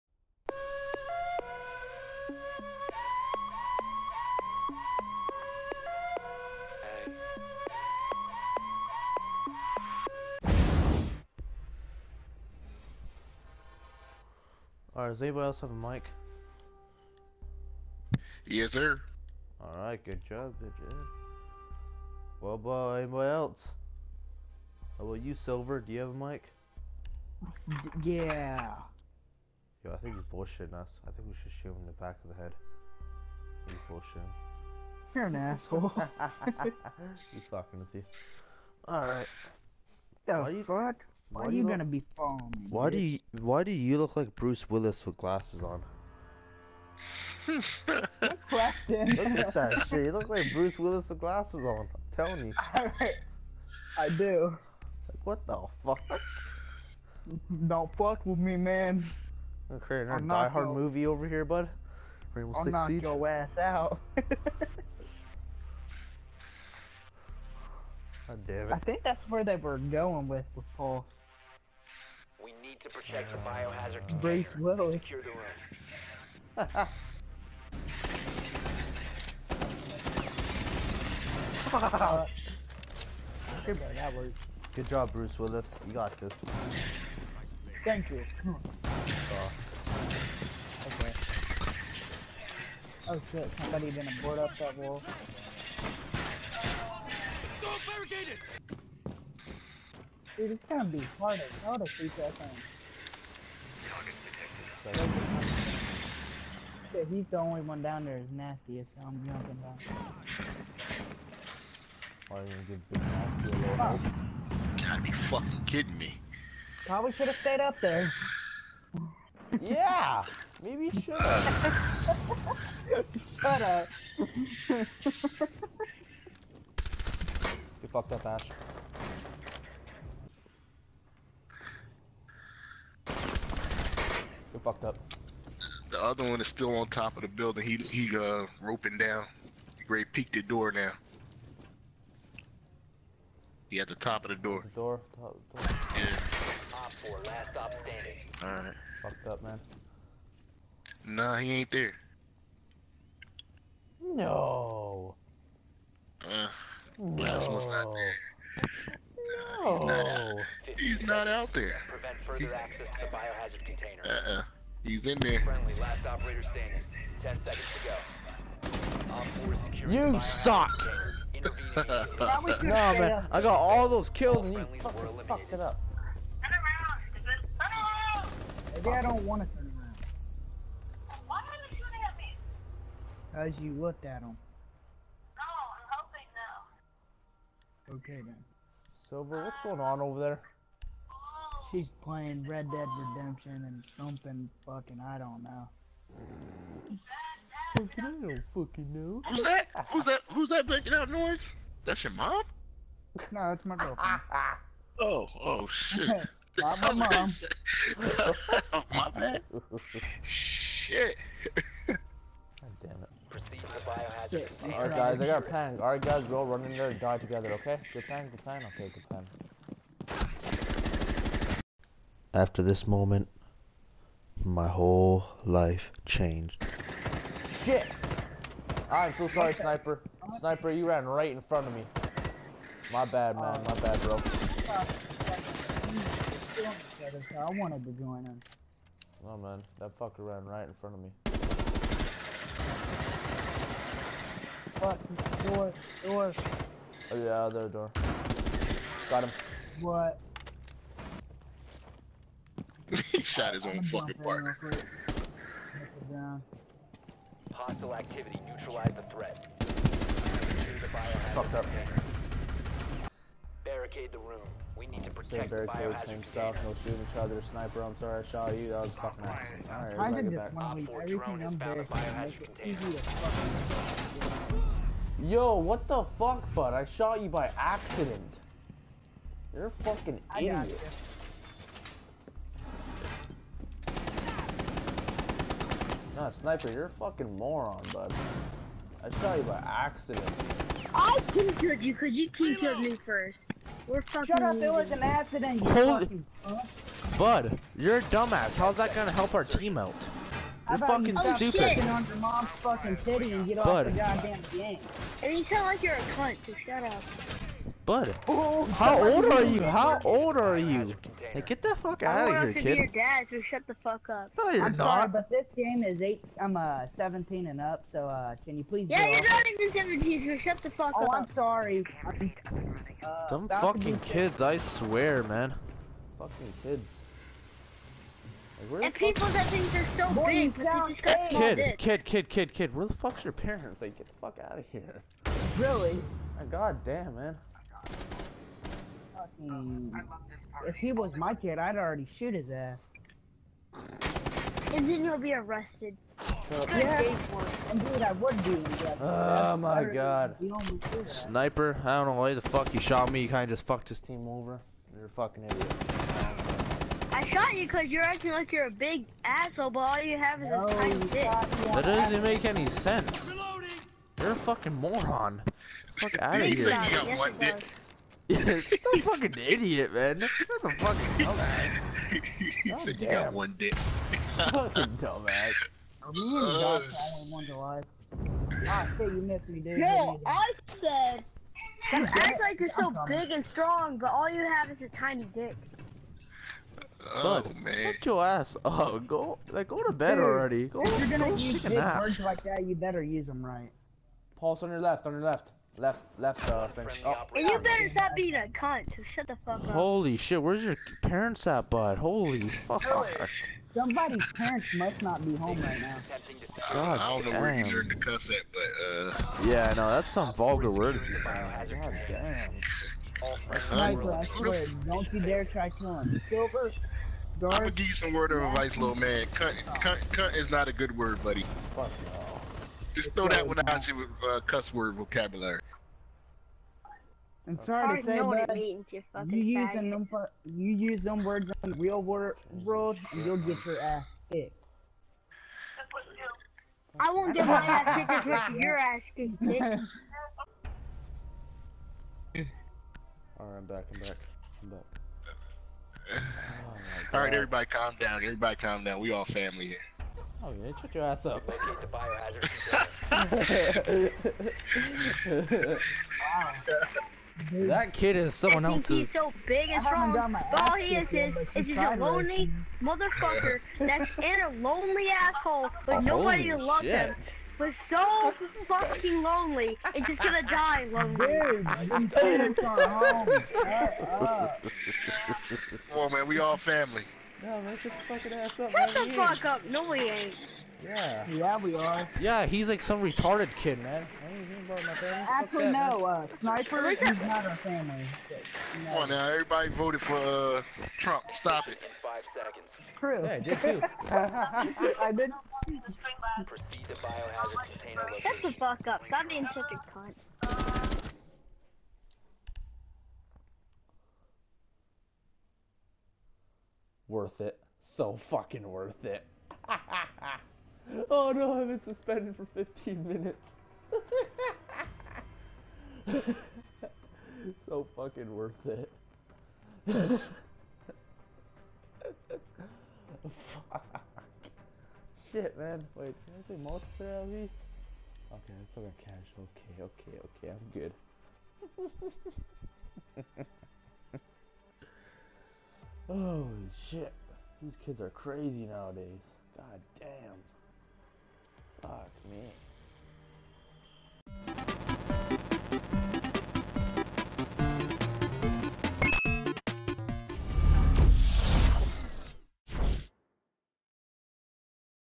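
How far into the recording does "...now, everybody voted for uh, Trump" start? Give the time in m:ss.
8:09.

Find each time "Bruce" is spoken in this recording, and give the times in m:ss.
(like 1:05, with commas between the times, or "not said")
0:44, 0:50, 1:25.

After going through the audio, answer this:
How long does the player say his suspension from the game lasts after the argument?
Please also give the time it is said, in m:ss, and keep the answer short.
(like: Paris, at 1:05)
15 minutes, at 8:32.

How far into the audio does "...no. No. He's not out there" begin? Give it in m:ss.
2:36.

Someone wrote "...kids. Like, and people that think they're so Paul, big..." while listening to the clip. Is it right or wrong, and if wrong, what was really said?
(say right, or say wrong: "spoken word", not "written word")
wrong: "Boy", not "Paul".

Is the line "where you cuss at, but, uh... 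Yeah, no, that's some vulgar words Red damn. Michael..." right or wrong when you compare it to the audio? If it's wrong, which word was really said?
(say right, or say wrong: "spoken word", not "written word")
wrong: "God", not "Red".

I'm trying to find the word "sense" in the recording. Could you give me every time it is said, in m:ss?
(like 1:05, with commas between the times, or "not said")
6:02.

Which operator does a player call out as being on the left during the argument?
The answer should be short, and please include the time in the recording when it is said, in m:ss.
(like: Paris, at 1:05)
Pulse, at 6:34.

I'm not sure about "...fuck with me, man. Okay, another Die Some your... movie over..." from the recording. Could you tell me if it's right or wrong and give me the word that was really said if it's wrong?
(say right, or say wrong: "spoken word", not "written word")
wrong: "Hard", not "Some".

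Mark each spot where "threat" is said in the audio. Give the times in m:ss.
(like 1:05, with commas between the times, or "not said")
4:19.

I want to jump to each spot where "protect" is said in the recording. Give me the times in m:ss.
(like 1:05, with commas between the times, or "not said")
1:12, 4:25.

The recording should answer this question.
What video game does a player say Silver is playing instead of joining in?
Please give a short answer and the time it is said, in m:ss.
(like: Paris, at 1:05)
Red Dead Redemption, at 3:12.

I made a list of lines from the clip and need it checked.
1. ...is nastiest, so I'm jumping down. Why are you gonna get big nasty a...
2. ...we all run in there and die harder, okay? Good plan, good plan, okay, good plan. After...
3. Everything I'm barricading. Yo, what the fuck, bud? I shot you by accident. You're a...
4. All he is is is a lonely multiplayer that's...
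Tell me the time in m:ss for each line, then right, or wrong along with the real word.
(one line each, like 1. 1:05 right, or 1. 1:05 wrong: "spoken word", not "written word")
1. 1:48 right
2. 3:36 wrong: "together", not "harder"
3. 4:30 right
4. 7:40 wrong: "motherfucker", not "multiplayer".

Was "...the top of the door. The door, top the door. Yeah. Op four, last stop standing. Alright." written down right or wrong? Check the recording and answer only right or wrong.
right.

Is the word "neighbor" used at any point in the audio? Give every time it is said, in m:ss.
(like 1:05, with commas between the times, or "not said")
not said.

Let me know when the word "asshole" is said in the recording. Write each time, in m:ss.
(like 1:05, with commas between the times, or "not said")
0:35, 5:59, 7:45.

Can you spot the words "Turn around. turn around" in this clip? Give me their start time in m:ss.
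2:56.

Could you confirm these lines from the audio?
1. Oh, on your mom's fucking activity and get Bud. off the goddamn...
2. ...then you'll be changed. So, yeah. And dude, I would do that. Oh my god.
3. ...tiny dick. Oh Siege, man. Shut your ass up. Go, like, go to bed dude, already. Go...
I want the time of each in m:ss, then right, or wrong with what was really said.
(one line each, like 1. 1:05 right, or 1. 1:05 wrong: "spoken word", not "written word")
1. 5:01 wrong: "titty", not "activity"
2. 5:44 wrong: "arrested", not "changed"
3. 6:24 wrong: "Bud", not "Siege".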